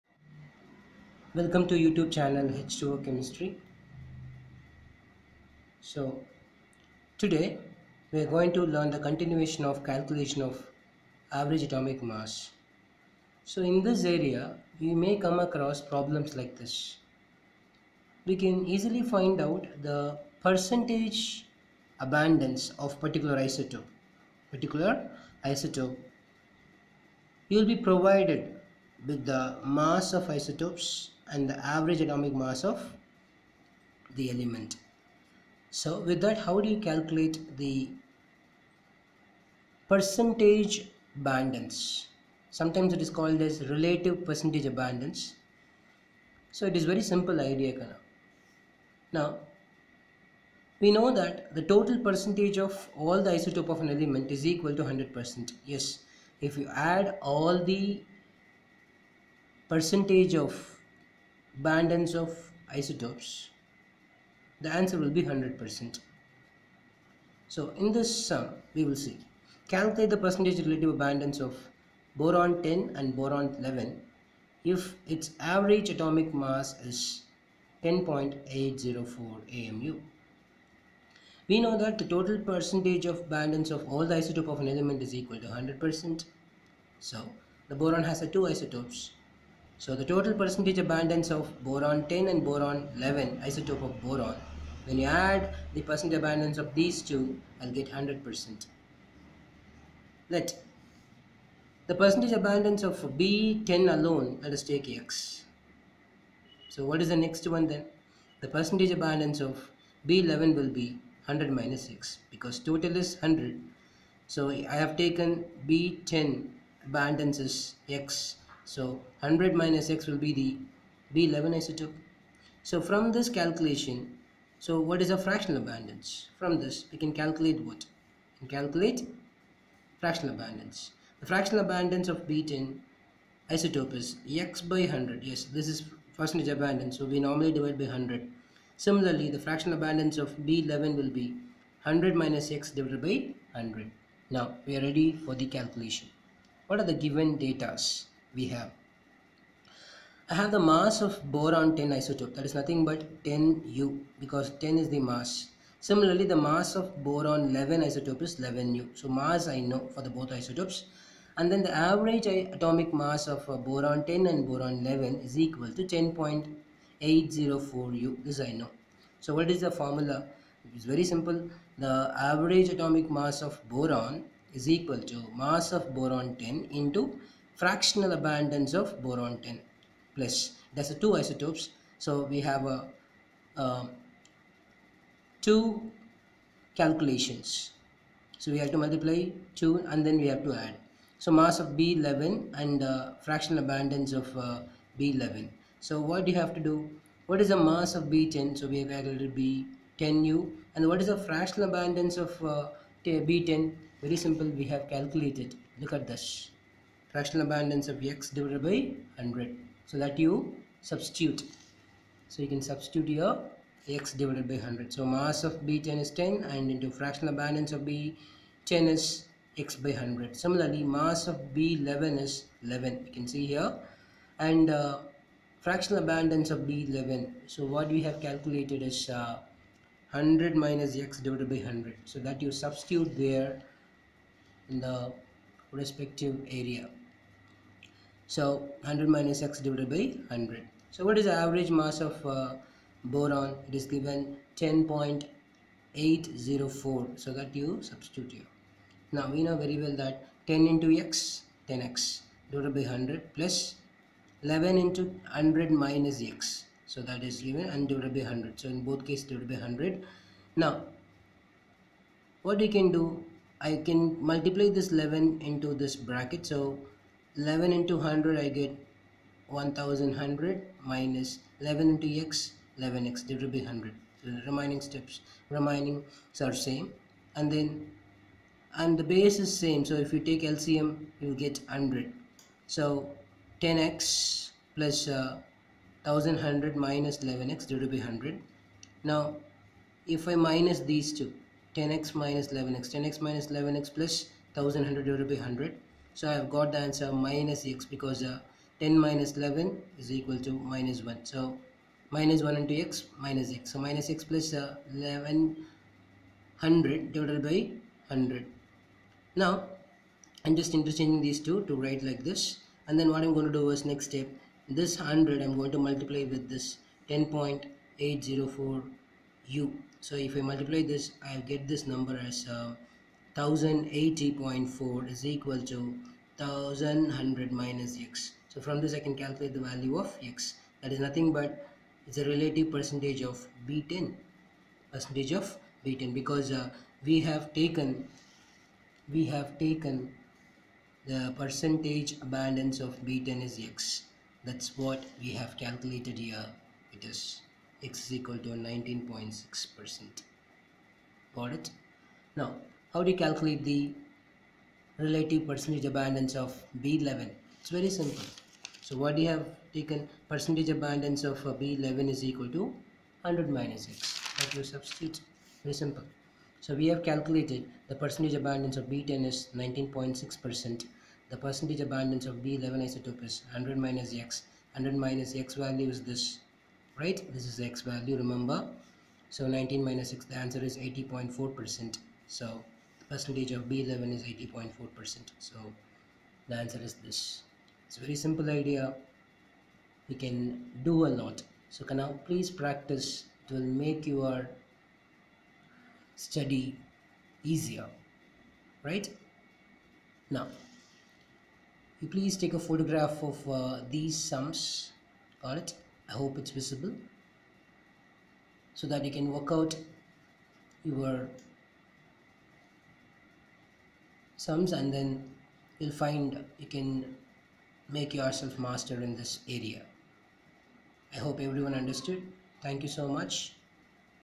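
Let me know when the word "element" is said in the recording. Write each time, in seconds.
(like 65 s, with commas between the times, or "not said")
34 s, 53 s, 84 s.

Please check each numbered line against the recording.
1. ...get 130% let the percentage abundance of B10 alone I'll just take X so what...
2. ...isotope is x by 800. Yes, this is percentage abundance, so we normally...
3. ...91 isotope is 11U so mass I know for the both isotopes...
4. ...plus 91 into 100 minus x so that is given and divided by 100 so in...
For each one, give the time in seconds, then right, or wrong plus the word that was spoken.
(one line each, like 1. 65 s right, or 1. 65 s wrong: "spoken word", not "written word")
1. 97 s wrong: "100", not "130"
2. 133 s wrong: "100", not "800"
3. 157 s wrong: "11", not "91"
4. 253 s wrong: "11", not "91".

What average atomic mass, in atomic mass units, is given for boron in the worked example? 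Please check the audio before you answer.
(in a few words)
10.804 AMU.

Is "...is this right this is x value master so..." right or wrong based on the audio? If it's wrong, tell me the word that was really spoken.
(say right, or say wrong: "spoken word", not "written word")
wrong: "remember", not "master".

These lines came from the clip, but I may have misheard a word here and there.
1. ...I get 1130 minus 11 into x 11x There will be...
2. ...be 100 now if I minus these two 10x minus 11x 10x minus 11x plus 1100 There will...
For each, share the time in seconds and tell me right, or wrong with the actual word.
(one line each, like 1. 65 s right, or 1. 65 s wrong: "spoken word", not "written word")
1. 268 s wrong: "1100", not "1130"
2. 287 s right.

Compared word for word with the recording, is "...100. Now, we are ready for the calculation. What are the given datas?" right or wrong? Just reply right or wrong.
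right.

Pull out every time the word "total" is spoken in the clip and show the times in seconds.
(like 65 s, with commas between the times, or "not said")
51 s, 82 s, 90 s, 112 s.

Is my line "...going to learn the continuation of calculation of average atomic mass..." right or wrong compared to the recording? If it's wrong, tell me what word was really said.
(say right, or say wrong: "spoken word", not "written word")
right.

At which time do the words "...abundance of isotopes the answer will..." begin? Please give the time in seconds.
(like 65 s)
61 s.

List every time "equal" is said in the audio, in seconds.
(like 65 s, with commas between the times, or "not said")
54 s, 85 s, 165 s, 174 s, 300 s, 325 s, 348 s, 362 s.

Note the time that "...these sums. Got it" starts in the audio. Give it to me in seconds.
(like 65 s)
403 s.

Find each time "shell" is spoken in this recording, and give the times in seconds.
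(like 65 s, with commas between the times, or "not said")
not said.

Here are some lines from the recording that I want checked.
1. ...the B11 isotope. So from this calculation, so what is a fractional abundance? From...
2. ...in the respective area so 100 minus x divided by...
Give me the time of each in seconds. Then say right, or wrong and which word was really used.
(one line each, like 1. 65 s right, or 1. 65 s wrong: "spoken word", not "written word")
1. 120 s right
2. 234 s right.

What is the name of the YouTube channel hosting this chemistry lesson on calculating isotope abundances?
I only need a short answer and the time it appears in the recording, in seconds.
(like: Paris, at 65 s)
H2O Chemistry, at 2 s.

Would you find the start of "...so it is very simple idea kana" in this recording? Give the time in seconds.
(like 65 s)
46 s.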